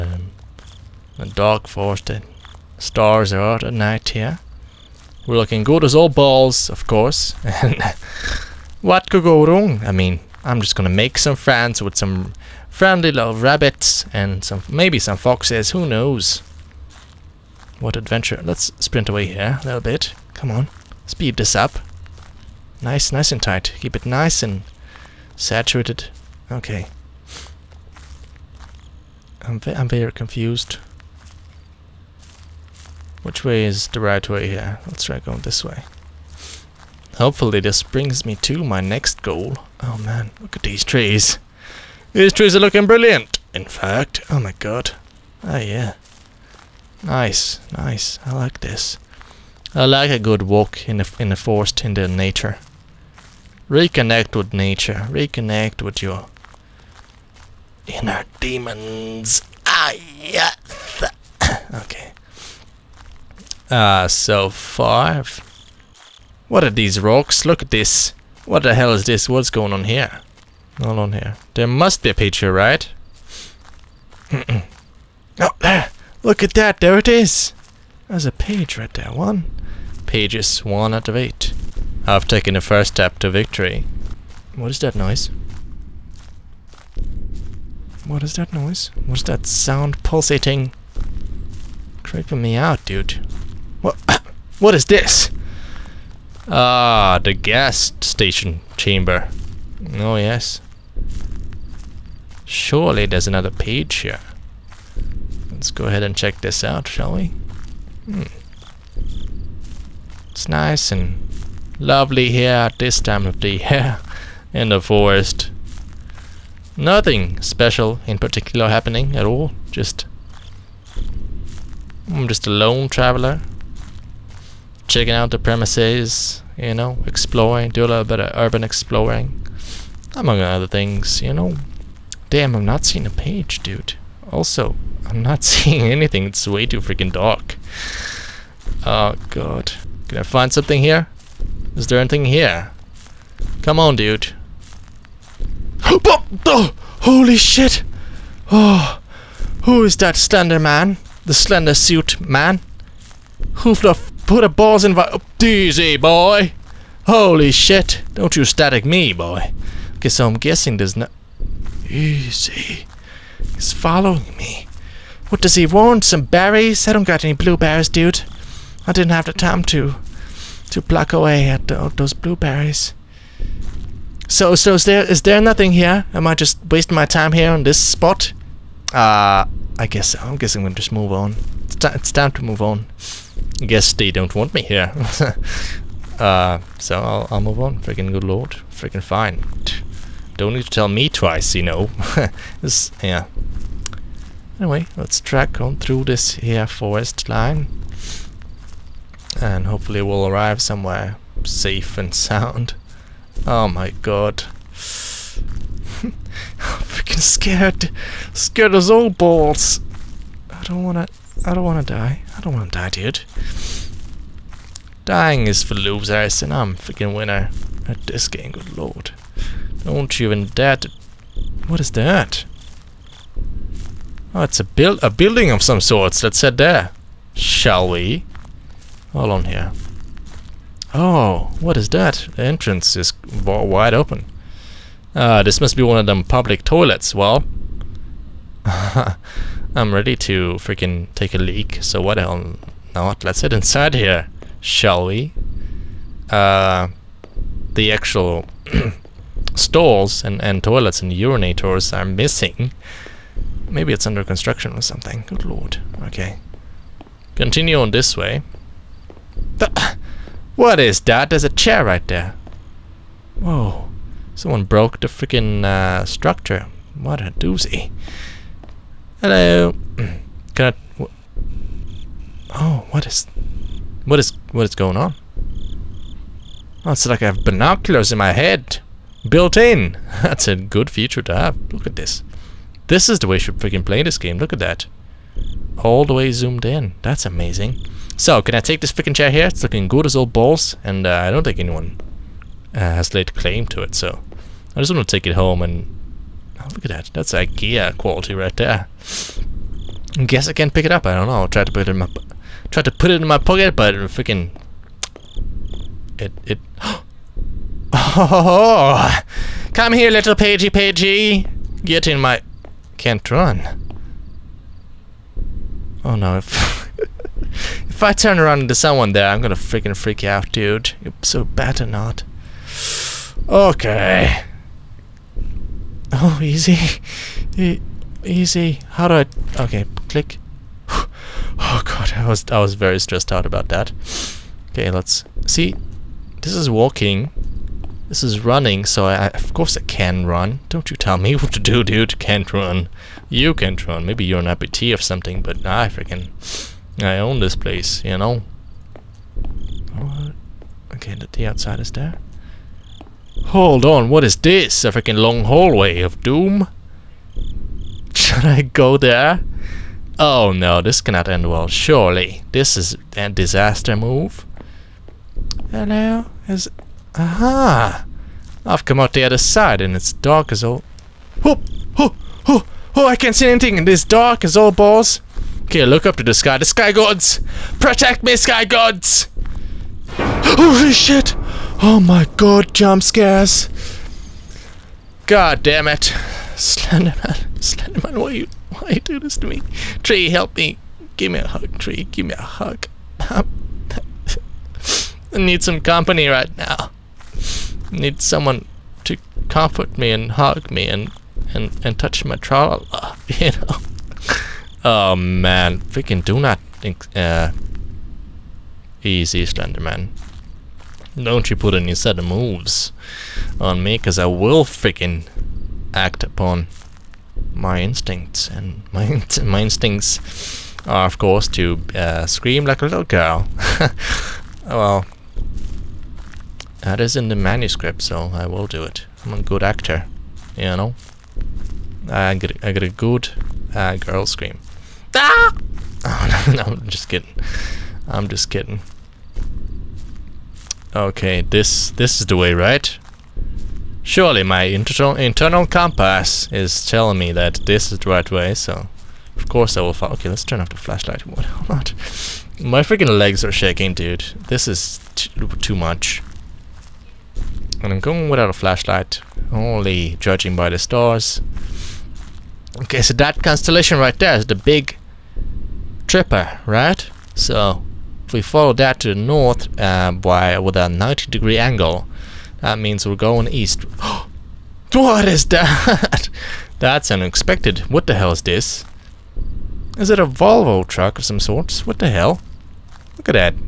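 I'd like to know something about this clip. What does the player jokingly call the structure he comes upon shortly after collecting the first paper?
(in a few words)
the gas station chamber.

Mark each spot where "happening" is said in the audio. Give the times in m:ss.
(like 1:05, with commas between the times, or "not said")
1:58.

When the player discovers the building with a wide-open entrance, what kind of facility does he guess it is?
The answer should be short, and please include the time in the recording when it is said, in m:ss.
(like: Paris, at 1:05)
public toilets, at 3:56.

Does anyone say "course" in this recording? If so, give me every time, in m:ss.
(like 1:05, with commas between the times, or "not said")
0:06, 5:39, 7:01, 7:29.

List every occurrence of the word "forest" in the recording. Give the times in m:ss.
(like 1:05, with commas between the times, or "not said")
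0:01, 0:51, 1:54, 3:16.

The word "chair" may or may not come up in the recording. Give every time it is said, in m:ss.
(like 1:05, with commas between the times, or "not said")
4:21, 4:49.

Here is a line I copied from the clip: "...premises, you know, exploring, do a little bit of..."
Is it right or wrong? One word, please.
right.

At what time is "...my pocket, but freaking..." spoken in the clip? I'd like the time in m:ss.
5:03.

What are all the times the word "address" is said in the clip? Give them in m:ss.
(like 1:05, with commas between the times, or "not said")
not said.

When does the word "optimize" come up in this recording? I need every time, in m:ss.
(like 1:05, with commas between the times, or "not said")
not said.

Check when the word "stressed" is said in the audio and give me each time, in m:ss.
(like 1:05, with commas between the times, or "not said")
5:32.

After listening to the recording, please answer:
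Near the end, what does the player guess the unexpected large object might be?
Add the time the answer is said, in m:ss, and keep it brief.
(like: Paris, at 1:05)
Volvo, at 8:00.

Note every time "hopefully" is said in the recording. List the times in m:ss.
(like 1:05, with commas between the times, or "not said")
0:37, 3:19.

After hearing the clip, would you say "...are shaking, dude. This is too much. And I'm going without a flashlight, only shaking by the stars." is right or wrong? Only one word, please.
wrong.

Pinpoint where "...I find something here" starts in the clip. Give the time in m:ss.
2:20.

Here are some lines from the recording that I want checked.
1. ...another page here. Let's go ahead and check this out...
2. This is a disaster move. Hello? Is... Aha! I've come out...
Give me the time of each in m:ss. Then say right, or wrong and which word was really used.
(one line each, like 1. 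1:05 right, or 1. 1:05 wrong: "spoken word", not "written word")
1. 1:43 right
2. 6:02 right.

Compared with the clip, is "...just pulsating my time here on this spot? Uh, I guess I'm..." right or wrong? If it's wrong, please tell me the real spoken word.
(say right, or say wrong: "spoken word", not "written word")
wrong: "wasting", not "pulsating".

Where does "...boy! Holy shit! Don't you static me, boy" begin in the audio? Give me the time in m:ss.
2:35.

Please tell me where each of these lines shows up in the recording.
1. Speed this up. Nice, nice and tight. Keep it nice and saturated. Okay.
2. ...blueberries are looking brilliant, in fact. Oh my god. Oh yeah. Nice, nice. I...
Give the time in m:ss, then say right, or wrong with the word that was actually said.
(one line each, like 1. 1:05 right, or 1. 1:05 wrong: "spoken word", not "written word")
1. 0:21 right
2. 0:42 wrong: "trees", not "blueberries".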